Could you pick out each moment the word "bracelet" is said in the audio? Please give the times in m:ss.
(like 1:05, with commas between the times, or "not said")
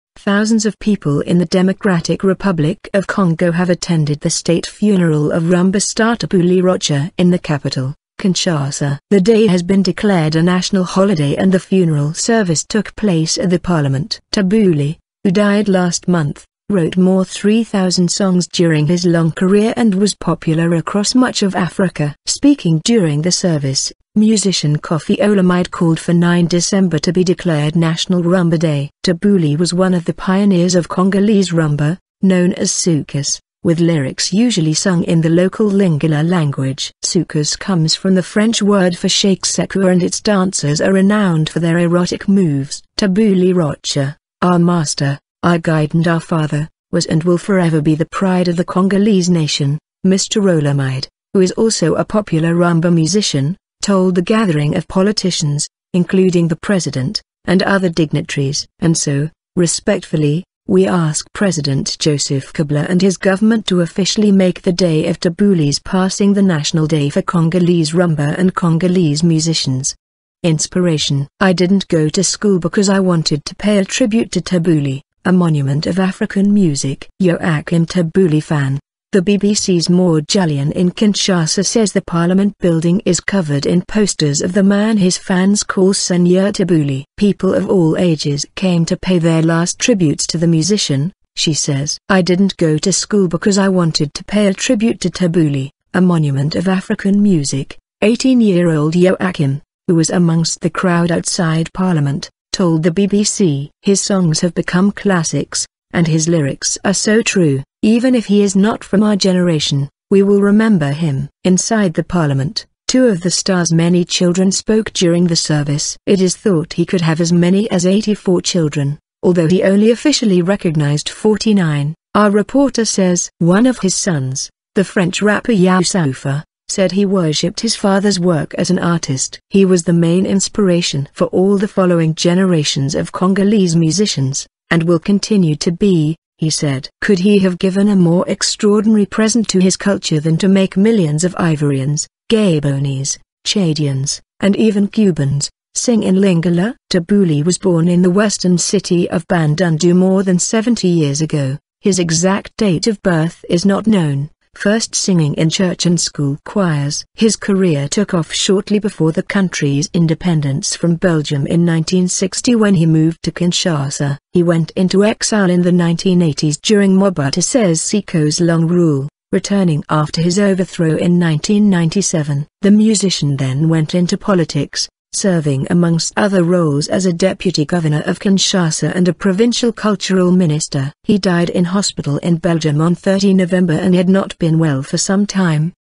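not said.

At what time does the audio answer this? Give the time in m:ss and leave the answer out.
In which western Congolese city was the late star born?
2:29.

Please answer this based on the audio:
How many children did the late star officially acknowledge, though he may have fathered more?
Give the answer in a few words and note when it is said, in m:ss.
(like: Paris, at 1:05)
49, at 2:01.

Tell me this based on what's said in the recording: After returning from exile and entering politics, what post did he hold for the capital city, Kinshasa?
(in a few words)
Deputy governor.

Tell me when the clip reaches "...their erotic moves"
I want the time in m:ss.
0:41.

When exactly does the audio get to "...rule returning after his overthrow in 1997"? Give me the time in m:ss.
2:48.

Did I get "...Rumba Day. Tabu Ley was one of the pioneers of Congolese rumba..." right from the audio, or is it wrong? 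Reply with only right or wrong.
right.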